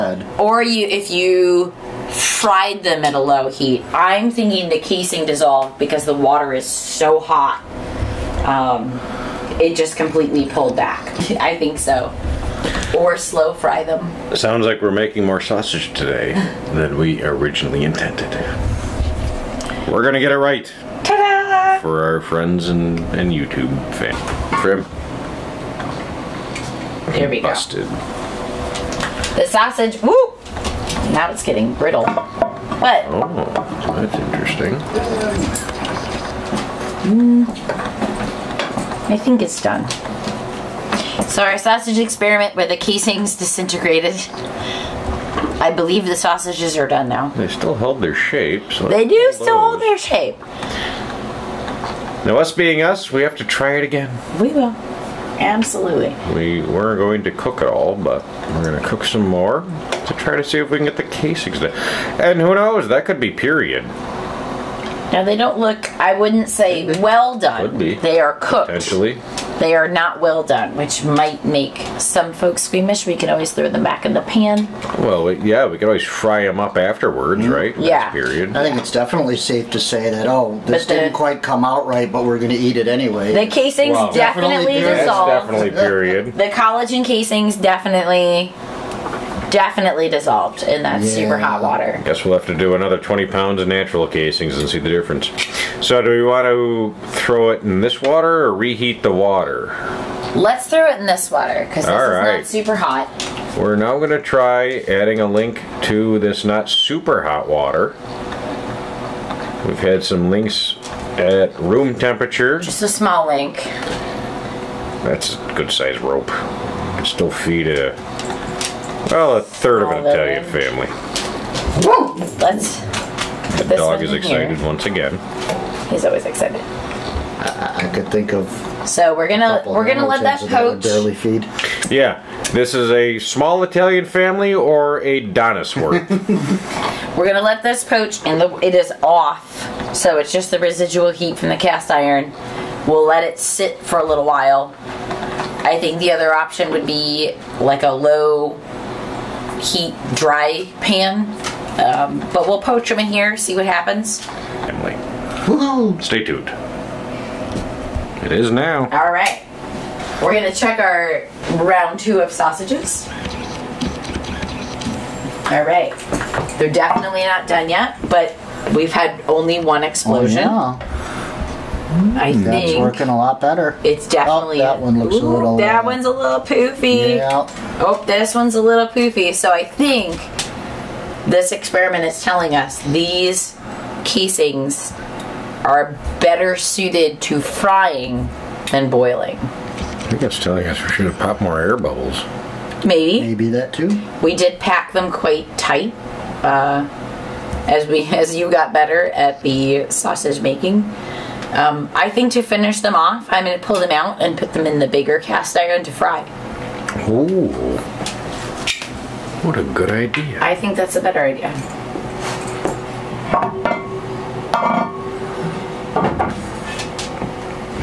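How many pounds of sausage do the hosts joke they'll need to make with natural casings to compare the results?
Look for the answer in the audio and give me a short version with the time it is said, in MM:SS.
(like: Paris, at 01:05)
20, at 01:32.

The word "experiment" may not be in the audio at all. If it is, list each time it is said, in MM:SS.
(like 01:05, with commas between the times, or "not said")
00:41, 03:01.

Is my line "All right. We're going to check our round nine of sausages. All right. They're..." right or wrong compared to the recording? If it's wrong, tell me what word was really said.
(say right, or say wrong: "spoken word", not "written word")
wrong: "two", not "nine".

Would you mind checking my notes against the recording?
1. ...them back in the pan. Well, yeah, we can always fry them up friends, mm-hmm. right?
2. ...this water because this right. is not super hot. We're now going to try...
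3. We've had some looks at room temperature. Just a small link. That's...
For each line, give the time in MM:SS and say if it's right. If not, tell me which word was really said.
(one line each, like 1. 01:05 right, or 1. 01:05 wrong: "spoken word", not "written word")
1. 01:13 wrong: "afterwards", not "friends"
2. 01:41 right
3. 01:49 wrong: "links", not "looks".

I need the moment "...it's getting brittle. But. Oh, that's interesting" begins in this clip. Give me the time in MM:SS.
00:31.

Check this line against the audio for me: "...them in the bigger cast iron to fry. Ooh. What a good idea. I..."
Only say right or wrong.
right.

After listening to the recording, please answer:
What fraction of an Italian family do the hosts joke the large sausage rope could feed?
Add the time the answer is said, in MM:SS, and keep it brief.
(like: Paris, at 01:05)
A third, at 01:59.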